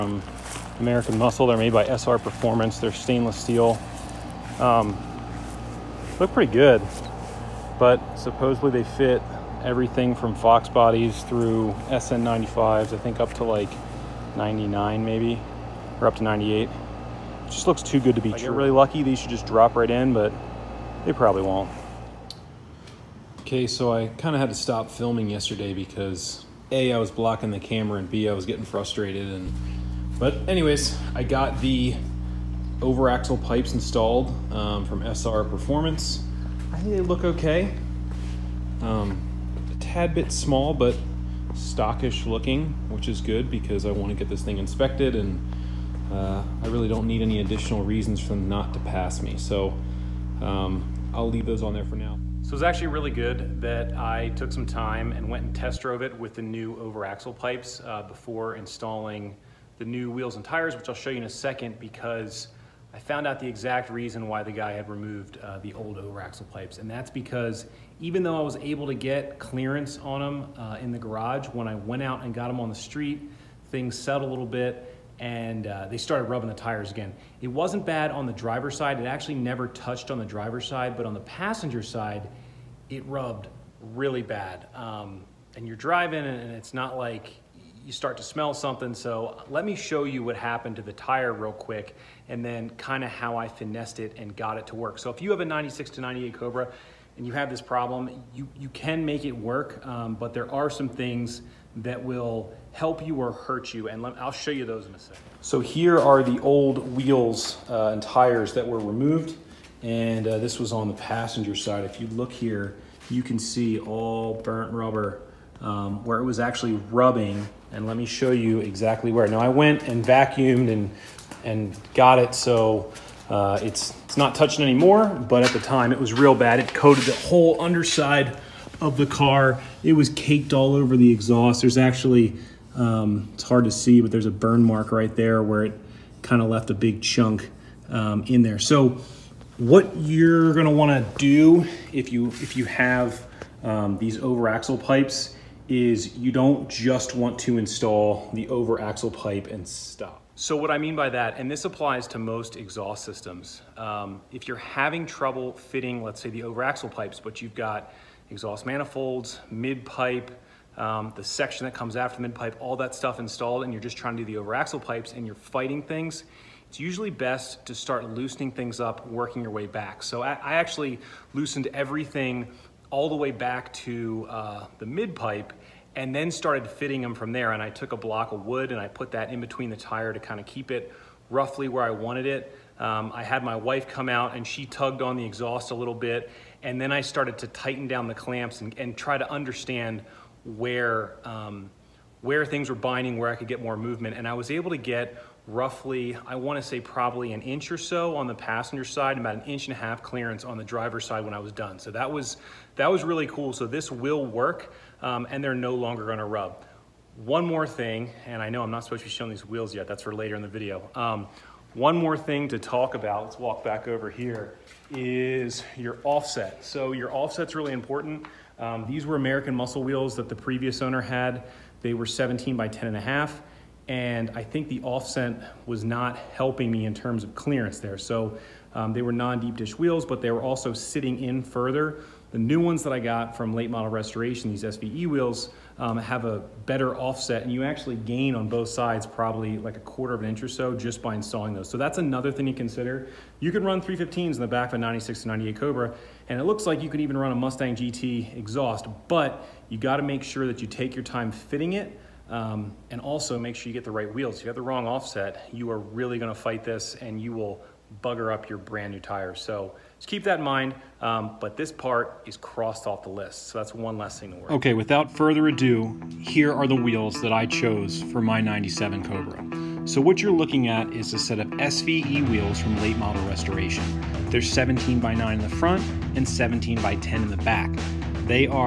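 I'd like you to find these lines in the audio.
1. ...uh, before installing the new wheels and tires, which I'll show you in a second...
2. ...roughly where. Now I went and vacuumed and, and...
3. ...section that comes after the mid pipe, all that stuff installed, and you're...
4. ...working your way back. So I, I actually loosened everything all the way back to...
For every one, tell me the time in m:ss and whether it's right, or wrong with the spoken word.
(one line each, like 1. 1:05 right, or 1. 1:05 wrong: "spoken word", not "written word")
1. 0:57 right
2. 1:58 wrong: "exactly", not "roughly"
3. 2:41 right
4. 2:49 right.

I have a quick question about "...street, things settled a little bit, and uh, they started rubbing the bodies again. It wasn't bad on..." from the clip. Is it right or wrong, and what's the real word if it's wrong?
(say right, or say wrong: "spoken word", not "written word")
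wrong: "tires", not "bodies".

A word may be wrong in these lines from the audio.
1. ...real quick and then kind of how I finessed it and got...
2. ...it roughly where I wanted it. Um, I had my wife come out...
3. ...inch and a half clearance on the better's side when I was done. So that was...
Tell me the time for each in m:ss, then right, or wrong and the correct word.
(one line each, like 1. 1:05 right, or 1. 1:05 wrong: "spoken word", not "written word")
1. 1:31 right
2. 3:00 right
3. 3:19 wrong: "driver", not "better".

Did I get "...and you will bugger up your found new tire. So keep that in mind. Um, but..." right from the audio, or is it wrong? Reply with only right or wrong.
wrong.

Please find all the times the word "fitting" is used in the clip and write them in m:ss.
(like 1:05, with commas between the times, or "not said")
2:35, 2:56, 4:11.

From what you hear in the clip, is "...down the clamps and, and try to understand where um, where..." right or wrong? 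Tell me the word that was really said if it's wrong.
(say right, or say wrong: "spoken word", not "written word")
right.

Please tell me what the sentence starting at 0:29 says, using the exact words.
And But anyways, I got the overaxle pipes installed um, from SR Performance.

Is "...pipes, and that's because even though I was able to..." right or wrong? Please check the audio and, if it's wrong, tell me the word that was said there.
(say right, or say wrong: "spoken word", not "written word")
right.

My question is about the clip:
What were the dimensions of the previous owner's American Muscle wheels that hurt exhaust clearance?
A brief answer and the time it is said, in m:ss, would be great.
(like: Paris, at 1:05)
17 by 10.5, at 3:42.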